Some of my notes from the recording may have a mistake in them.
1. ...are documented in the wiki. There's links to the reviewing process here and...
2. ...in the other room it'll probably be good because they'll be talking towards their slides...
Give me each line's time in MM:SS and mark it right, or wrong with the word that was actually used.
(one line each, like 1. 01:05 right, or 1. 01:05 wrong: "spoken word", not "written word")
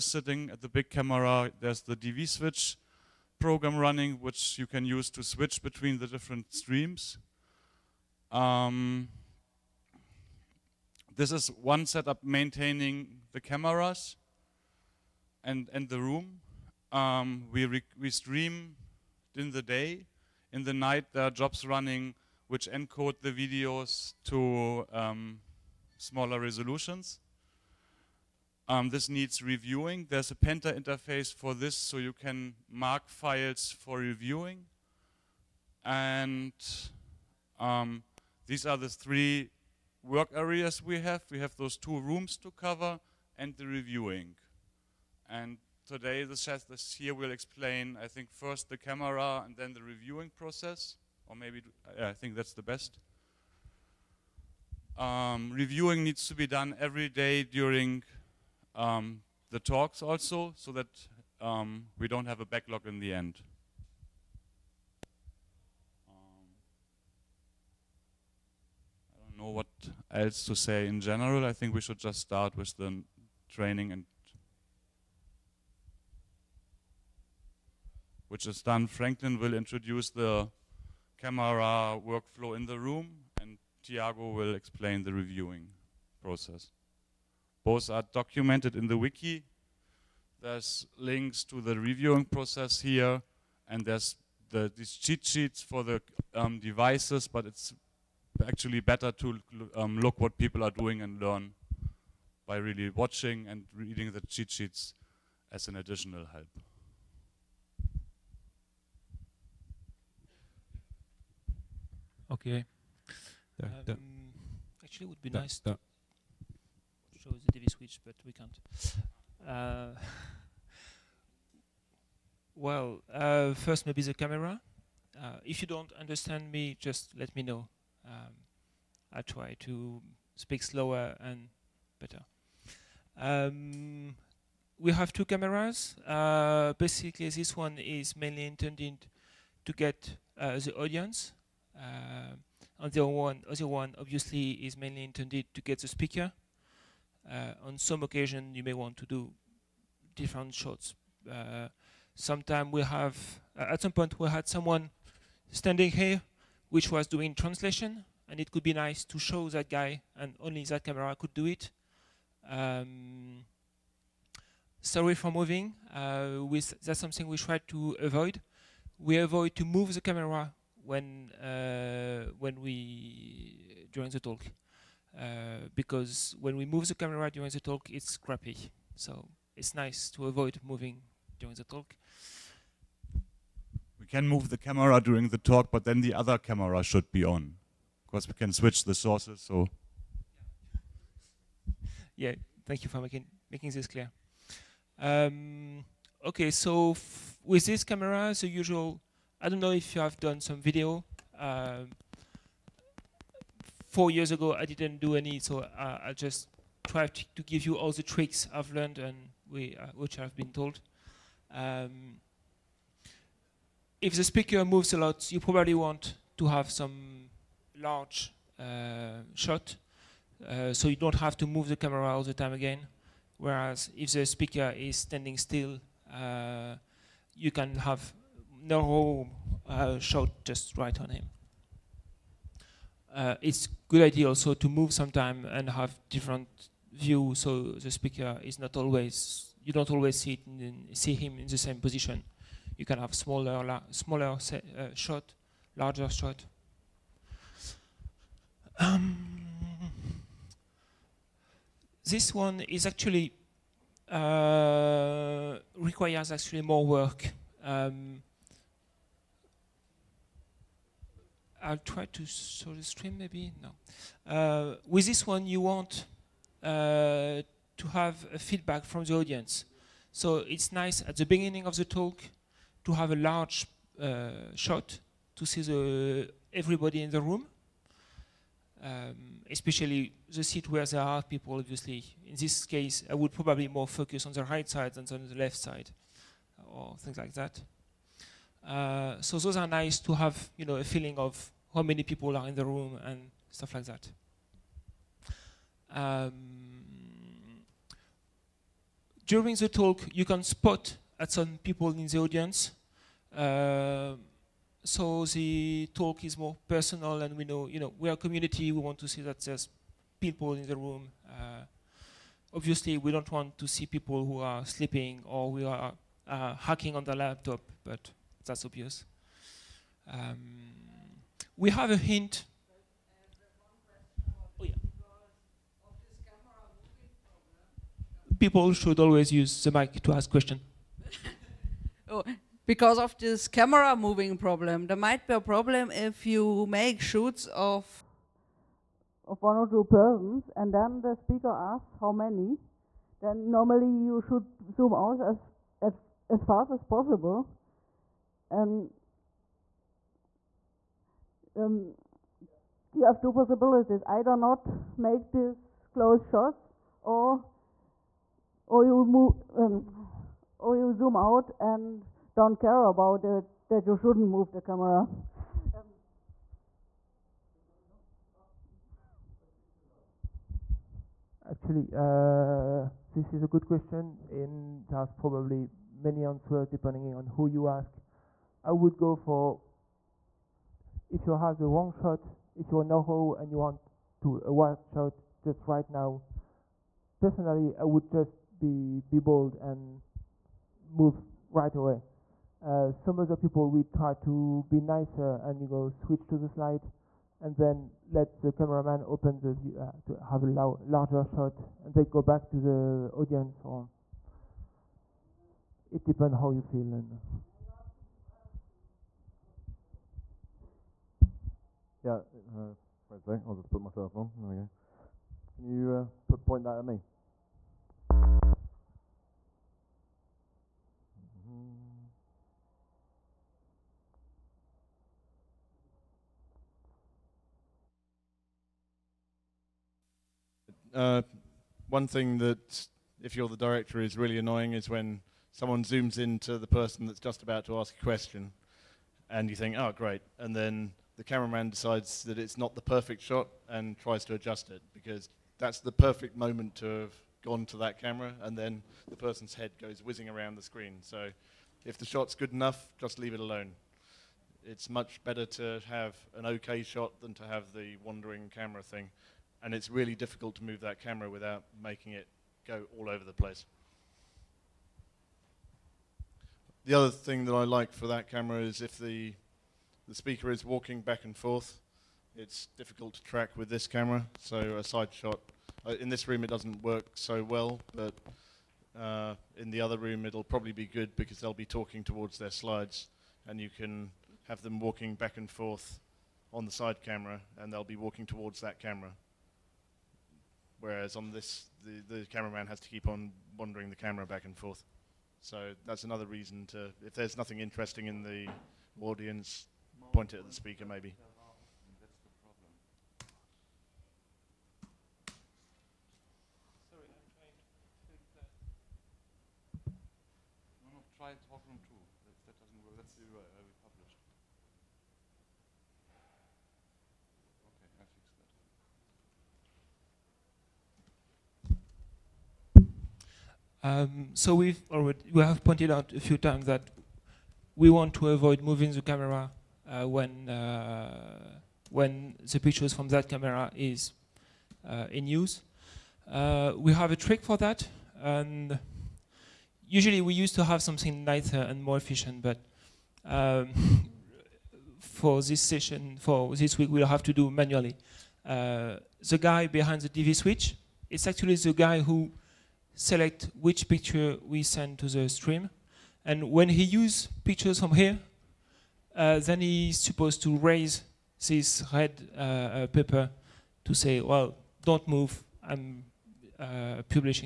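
1. 01:27 right
2. 07:59 right.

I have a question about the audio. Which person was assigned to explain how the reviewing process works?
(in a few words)
Tiago.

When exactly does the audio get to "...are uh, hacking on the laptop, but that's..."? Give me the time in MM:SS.
05:15.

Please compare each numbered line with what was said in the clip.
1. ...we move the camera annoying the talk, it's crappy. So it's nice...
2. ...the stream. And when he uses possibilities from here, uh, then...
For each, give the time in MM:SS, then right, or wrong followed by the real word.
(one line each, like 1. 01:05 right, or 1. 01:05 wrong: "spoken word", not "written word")
1. 02:56 wrong: "during", not "annoying"
2. 09:15 wrong: "pictures", not "possibilities".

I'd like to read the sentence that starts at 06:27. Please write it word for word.
Personally, I would just be be bold and move right away.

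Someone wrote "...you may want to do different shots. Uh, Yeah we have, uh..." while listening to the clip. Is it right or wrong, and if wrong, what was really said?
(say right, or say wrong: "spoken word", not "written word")
wrong: "Sometimes", not "Yeah".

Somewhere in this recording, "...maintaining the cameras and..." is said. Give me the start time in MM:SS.
00:12.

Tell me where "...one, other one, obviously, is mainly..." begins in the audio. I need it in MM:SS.
02:23.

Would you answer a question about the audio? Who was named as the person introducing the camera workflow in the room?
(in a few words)
Franklin.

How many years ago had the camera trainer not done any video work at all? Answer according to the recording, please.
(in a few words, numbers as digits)
4.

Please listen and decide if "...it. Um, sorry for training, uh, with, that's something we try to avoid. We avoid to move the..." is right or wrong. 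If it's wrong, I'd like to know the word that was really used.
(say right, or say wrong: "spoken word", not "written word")
wrong: "moving", not "training".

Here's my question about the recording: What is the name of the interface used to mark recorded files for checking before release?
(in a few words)
Penta.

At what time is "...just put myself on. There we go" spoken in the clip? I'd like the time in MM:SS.
06:53.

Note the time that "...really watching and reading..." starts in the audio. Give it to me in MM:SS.
01:42.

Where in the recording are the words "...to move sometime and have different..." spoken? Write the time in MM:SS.
03:54.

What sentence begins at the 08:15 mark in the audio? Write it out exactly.
So that's another reason to, if there's nothing interesting in the audience, point it at the speaker maybe.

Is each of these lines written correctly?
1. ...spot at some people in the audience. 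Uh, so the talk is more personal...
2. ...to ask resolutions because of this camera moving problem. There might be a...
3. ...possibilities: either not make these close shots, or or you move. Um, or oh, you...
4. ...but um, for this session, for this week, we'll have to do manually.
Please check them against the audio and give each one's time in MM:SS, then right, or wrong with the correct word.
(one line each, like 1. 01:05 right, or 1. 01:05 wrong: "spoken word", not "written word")
1. 05:00 right
2. 05:30 wrong: "questions", not "resolutions"
3. 05:53 right
4. 09:02 right.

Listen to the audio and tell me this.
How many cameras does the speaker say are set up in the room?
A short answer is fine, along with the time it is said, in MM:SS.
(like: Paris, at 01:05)
2, at 02:15.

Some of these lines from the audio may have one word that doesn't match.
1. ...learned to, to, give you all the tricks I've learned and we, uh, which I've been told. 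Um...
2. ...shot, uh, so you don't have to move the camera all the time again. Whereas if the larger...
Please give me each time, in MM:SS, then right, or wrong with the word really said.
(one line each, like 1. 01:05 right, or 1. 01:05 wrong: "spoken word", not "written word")
1. 03:26 wrong: "tried", not "learned"
2. 03:39 wrong: "speaker", not "larger".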